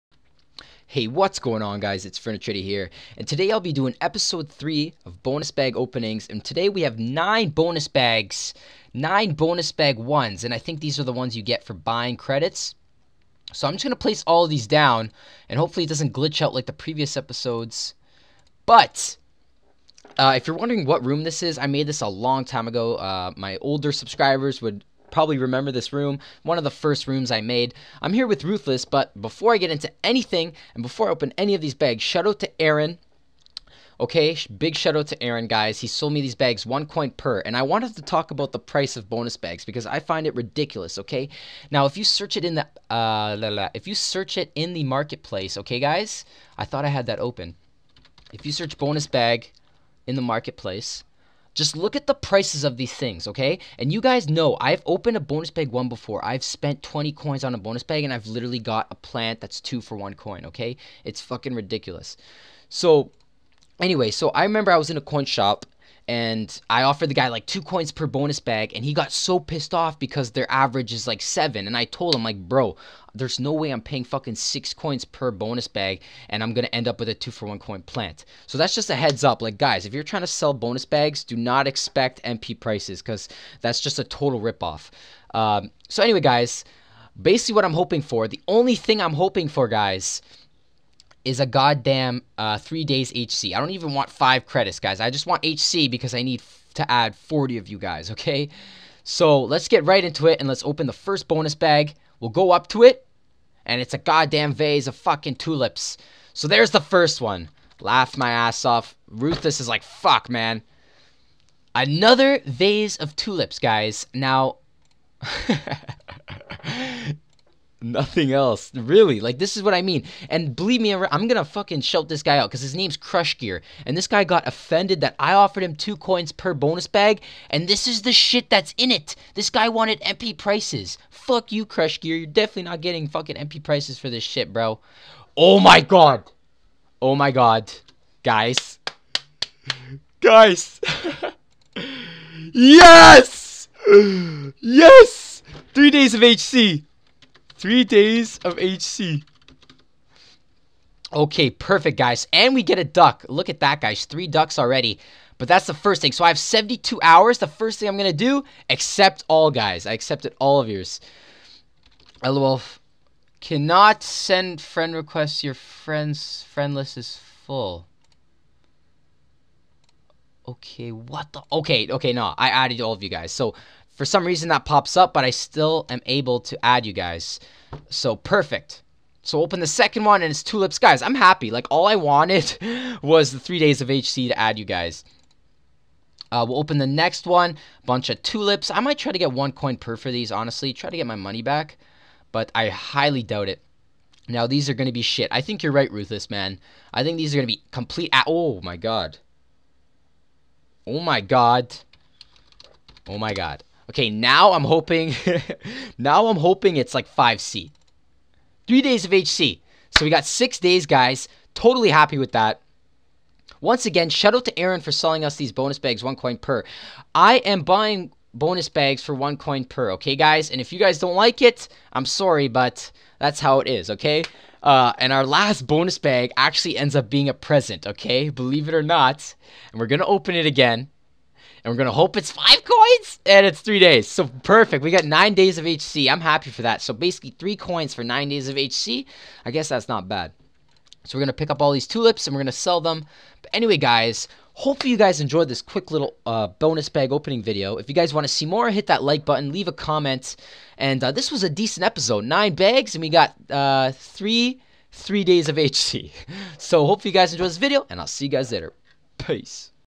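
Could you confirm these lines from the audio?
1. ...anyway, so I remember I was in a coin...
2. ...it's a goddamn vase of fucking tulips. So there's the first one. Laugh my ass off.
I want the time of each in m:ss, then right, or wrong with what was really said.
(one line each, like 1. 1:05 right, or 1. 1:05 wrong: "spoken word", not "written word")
1. 1:03 right
2. 1:43 right.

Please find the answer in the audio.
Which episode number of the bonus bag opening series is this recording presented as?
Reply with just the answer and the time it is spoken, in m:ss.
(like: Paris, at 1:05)
3, at 0:04.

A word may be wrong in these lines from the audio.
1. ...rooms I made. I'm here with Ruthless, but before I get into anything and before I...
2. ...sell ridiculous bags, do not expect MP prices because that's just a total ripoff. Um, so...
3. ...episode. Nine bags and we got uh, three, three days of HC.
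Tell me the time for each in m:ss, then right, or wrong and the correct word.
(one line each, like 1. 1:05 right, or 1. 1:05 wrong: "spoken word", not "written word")
1. 0:27 right
2. 1:20 wrong: "bonus", not "ridiculous"
3. 4:11 right.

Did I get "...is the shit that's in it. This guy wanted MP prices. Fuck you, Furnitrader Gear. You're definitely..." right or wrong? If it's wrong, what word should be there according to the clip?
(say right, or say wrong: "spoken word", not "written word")
wrong: "Crush", not "Furnitrader".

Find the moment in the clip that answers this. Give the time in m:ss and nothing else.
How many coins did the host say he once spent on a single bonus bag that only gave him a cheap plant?
0:56.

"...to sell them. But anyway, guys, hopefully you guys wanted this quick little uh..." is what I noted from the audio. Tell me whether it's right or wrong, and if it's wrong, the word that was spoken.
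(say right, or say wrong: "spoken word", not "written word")
wrong: "enjoyed", not "wanted".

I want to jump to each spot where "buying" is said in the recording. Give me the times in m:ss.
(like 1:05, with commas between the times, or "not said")
0:11, 3:37.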